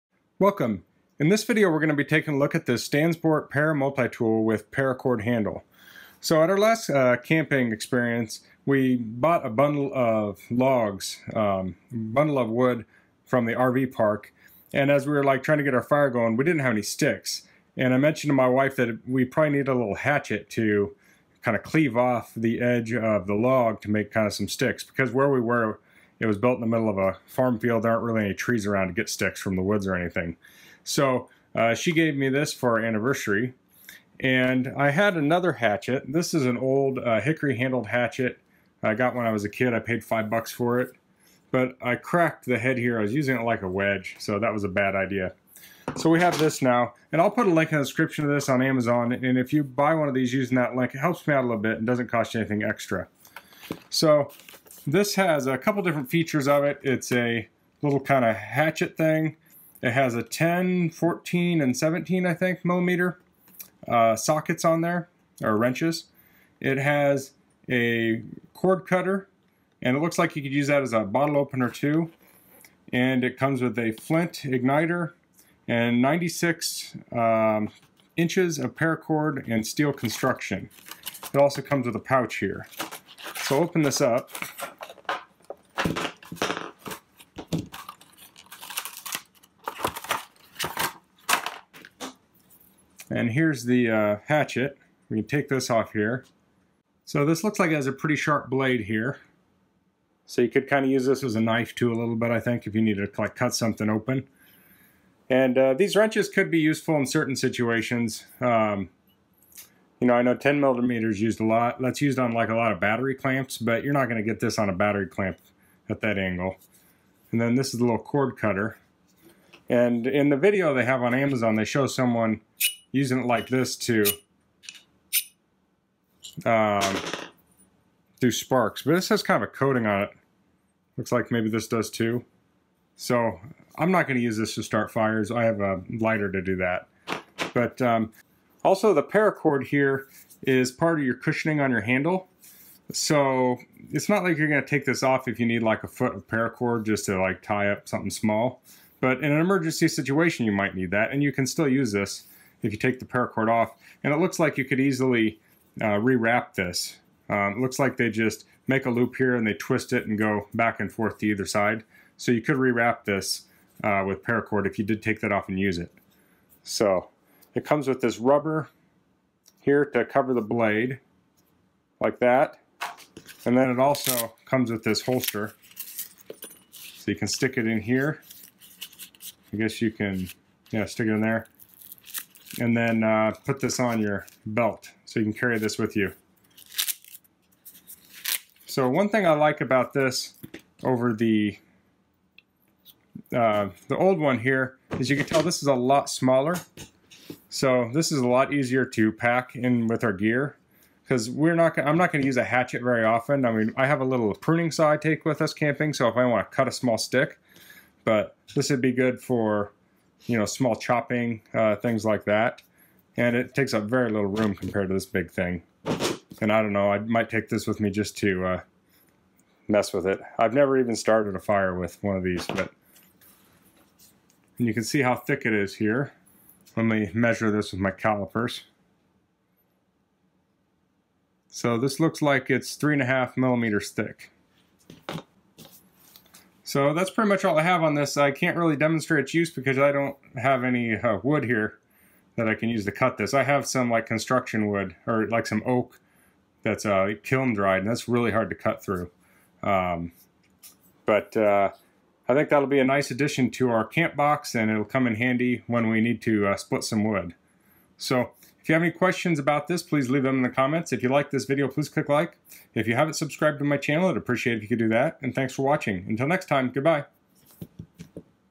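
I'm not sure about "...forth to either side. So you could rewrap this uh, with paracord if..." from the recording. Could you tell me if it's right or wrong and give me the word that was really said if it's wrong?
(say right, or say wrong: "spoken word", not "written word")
right.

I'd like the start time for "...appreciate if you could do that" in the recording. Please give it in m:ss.
4:24.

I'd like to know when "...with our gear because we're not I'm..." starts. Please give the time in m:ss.
3:19.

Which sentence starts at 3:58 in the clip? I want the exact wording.
I can't really demonstrate its use because I don't have any uh, wood here that I can use to cut this.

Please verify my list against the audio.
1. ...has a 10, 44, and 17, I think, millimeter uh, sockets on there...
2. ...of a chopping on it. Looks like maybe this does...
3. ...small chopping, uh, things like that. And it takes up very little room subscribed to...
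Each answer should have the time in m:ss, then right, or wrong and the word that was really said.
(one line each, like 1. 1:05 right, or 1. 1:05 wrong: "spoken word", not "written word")
1. 0:59 wrong: "14", not "44"
2. 2:09 wrong: "coating", not "chopping"
3. 3:30 wrong: "compared", not "subscribed".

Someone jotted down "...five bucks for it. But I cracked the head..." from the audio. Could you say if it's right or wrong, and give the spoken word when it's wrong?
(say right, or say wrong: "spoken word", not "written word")
right.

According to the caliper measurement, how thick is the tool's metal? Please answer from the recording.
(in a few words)
3.5 millimeters.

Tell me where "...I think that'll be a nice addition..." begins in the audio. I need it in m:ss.
4:12.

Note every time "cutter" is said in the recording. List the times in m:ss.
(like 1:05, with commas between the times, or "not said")
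1:08, 1:58.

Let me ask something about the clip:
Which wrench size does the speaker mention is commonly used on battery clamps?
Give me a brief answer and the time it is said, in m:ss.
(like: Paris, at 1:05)
10 millimeters, at 1:50.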